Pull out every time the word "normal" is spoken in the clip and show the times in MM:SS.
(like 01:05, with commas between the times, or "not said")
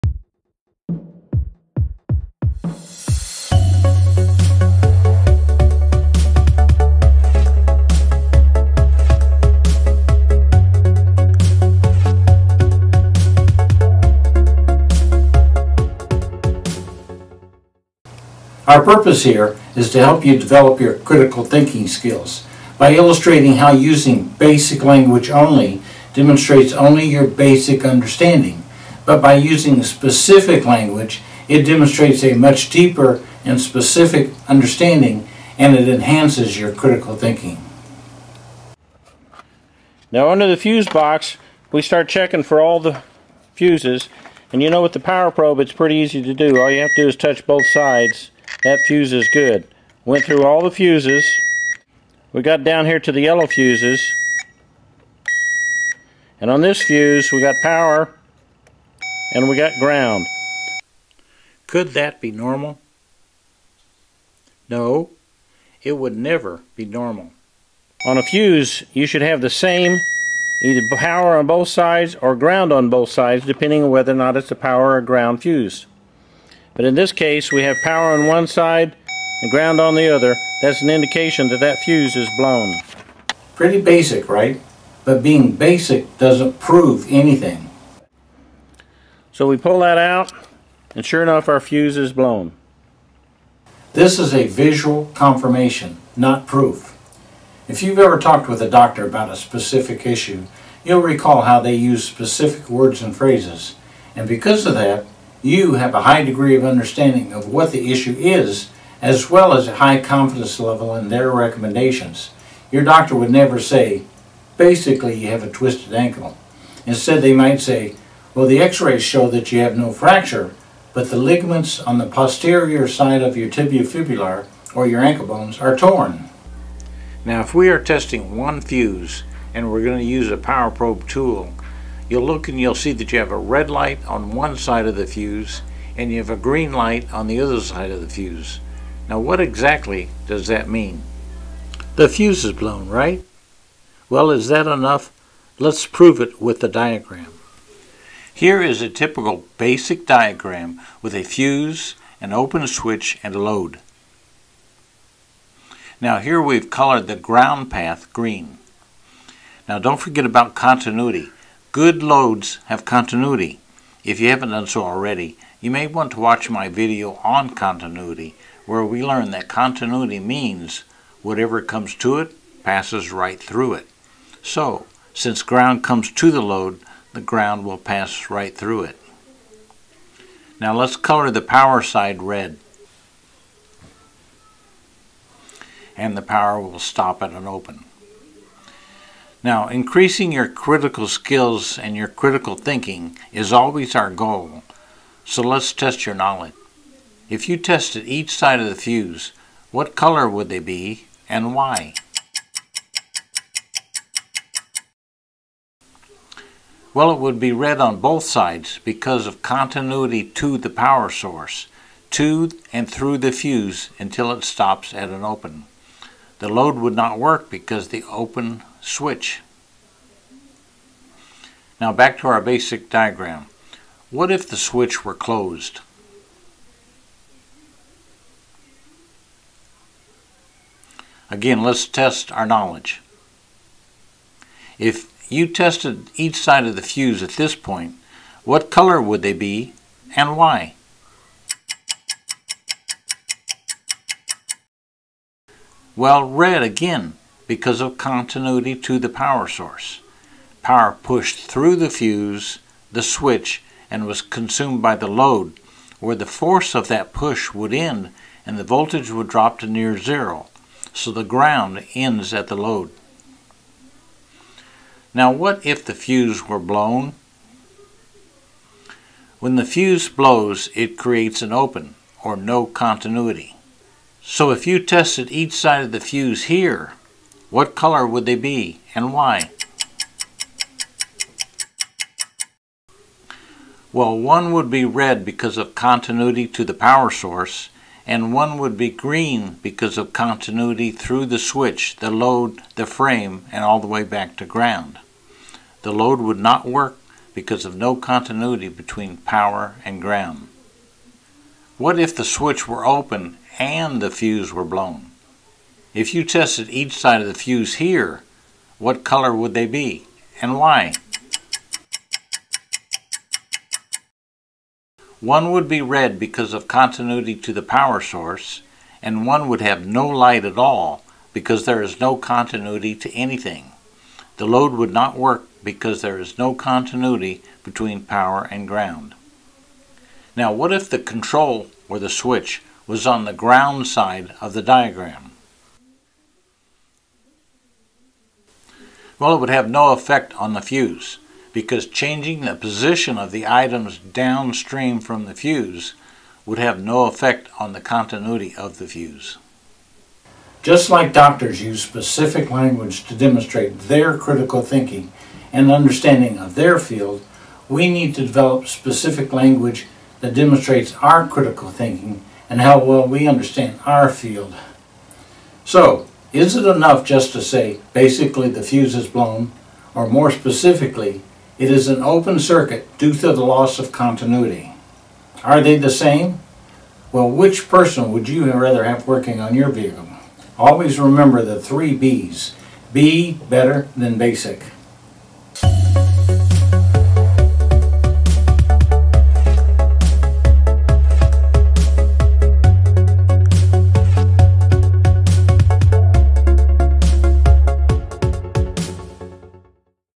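01:02, 01:06.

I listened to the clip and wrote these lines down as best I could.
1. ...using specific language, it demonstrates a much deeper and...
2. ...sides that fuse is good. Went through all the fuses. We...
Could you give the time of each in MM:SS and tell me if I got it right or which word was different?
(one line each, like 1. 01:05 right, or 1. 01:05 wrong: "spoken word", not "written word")
1. 00:29 right
2. 00:47 right.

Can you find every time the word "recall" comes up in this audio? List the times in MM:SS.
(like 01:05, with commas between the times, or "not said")
01:41.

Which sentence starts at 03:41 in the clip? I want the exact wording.
Now back to our basic diagram.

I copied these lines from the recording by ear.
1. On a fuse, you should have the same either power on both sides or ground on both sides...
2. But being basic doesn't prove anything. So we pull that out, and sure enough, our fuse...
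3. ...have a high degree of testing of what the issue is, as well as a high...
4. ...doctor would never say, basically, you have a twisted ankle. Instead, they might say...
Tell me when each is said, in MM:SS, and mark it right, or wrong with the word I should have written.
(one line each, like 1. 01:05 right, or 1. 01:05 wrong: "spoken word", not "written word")
1. 01:08 right
2. 01:25 right
3. 01:45 wrong: "understanding", not "testing"
4. 01:52 right.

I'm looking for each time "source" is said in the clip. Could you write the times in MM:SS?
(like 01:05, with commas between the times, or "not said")
03:31, 04:09, 04:47, 05:17.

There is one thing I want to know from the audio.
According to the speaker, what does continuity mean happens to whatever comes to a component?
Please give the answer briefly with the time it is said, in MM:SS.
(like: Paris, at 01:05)
passes right through it, at 02:52.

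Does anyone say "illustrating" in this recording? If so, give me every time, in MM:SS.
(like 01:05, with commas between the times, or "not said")
00:22.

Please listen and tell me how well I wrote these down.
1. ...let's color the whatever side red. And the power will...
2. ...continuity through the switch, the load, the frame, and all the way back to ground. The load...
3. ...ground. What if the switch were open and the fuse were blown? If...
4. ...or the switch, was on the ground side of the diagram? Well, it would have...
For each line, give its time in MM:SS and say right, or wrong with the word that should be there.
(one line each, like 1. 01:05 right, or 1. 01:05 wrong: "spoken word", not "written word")
1. 03:00 wrong: "power", not "whatever"
2. 04:50 right
3. 05:00 right
4. 05:31 right.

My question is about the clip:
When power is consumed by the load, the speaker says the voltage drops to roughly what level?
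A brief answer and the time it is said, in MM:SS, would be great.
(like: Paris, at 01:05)
near zero, at 04:19.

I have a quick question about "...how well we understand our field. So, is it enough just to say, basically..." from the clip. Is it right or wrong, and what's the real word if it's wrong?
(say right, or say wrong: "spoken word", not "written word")
right.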